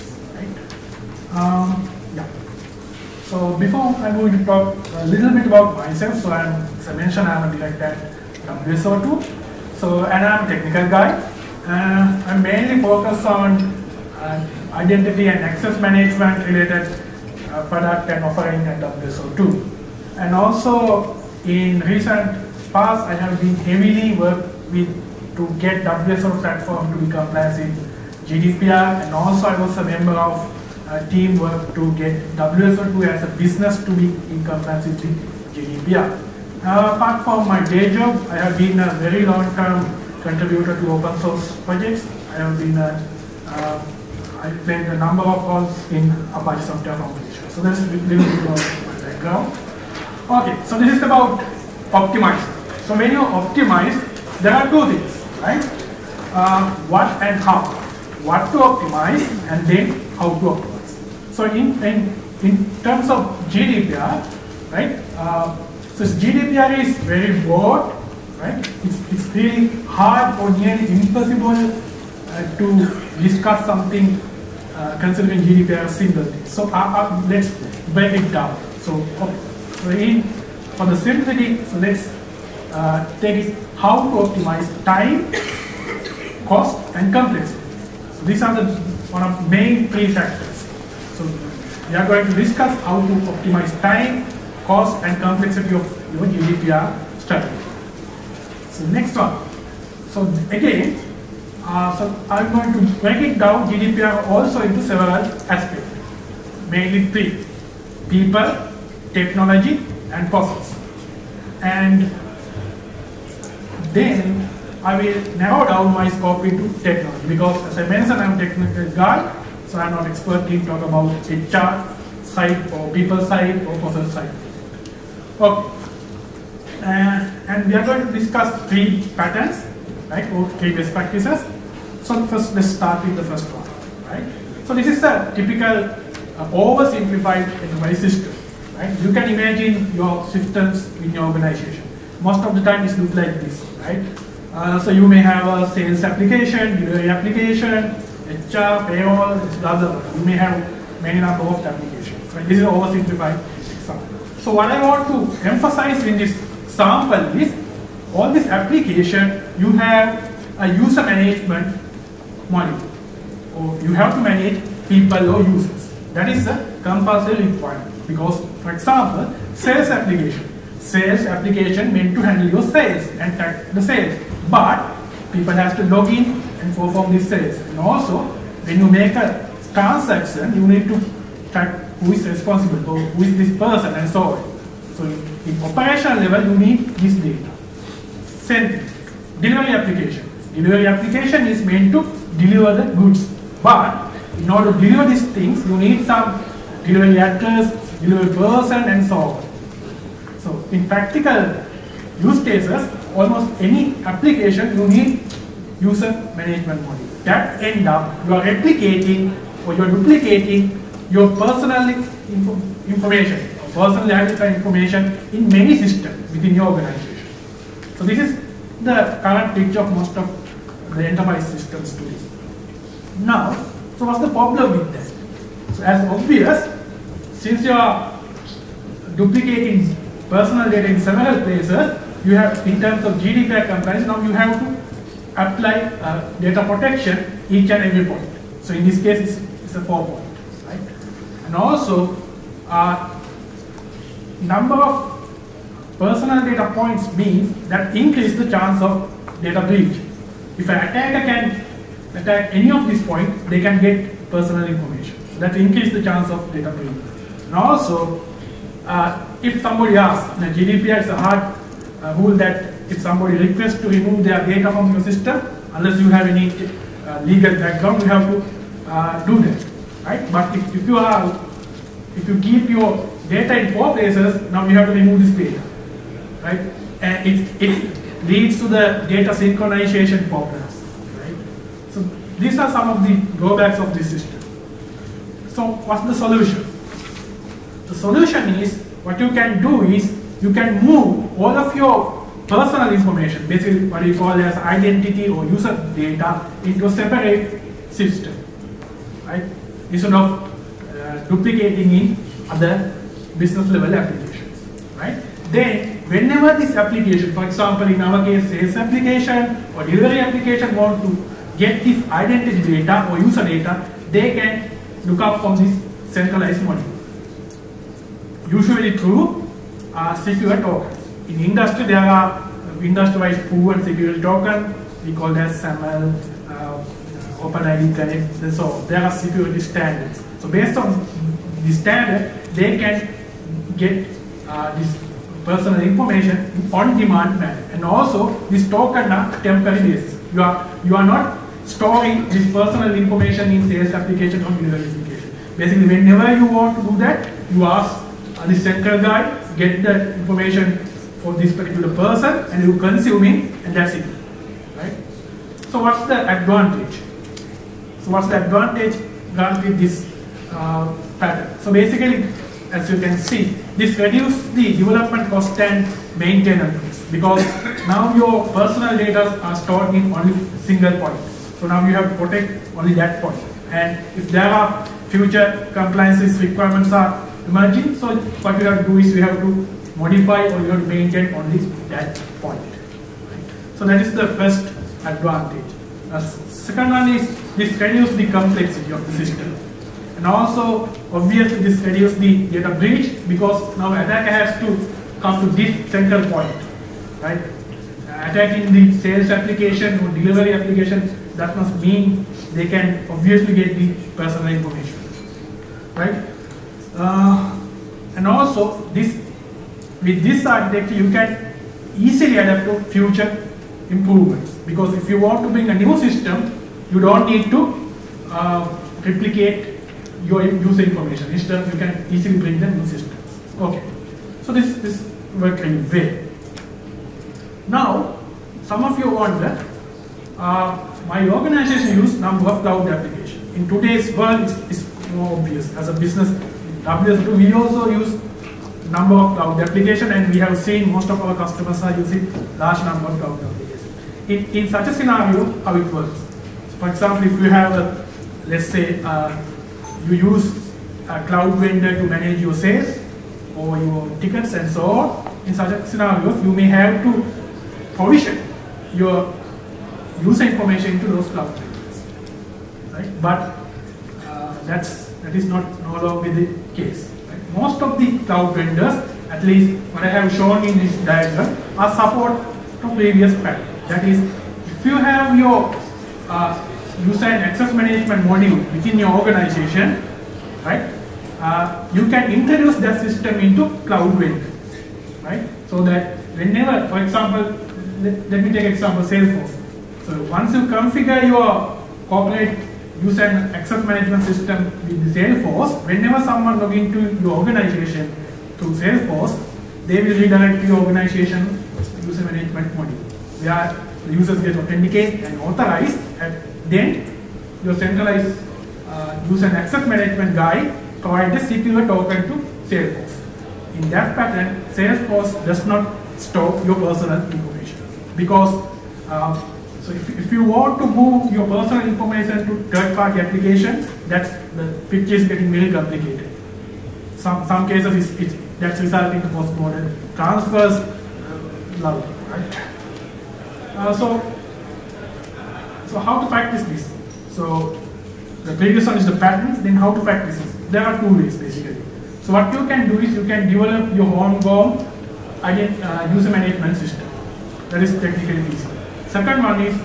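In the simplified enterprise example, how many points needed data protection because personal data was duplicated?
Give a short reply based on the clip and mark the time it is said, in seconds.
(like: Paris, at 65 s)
4, at 239 s.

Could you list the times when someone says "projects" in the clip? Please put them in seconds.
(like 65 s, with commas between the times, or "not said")
41 s.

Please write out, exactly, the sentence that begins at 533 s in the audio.
Uh, so so how to practice this?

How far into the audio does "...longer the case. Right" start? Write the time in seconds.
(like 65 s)
466 s.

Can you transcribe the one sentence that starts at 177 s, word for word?
And also, when you make a transaction, you need to track who is responsible, who is this person, and so on.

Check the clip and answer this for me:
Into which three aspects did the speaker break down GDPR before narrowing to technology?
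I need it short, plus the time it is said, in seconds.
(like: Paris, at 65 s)
people, technology, and process, at 108 s.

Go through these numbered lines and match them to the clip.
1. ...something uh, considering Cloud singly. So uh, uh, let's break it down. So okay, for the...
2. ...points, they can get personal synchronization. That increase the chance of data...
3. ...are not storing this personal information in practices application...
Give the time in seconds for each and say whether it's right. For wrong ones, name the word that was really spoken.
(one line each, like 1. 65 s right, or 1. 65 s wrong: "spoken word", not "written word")
1. 73 s wrong: "GDPR", not "Cloud"
2. 253 s wrong: "information", not "synchronization"
3. 340 s wrong: "sales", not "practices".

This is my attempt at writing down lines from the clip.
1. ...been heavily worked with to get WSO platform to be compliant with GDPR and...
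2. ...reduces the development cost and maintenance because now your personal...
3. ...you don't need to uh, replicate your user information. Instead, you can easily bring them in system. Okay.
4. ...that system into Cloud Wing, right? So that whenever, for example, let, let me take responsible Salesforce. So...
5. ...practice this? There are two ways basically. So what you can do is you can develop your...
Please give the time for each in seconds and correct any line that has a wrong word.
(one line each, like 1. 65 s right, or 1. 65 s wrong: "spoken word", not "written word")
1. 23 s right
2. 363 s right
3. 416 s right
4. 482 s wrong: "example", not "responsible"
5. 540 s right.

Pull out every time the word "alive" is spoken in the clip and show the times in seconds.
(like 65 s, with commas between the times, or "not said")
not said.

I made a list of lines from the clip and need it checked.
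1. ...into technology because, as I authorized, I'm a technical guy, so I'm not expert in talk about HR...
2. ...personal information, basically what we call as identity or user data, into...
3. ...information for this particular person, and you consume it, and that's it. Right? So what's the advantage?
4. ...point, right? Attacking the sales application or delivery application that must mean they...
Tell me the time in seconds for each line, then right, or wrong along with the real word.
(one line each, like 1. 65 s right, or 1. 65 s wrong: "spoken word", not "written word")
1. 116 s wrong: "mentioned", not "authorized"
2. 292 s right
3. 350 s right
4. 396 s right.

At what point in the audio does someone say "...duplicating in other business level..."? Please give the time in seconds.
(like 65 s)
301 s.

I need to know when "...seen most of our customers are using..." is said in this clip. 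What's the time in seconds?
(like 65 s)
440 s.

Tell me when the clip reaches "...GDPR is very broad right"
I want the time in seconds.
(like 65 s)
66 s.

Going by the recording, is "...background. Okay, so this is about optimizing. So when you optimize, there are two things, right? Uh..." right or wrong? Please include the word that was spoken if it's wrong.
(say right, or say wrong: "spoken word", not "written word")
right.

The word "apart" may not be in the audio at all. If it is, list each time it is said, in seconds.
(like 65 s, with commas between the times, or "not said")
36 s.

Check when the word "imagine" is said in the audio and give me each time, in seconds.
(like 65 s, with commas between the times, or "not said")
139 s.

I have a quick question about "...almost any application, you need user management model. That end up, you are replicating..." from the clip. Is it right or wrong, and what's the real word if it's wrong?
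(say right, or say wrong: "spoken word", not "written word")
right.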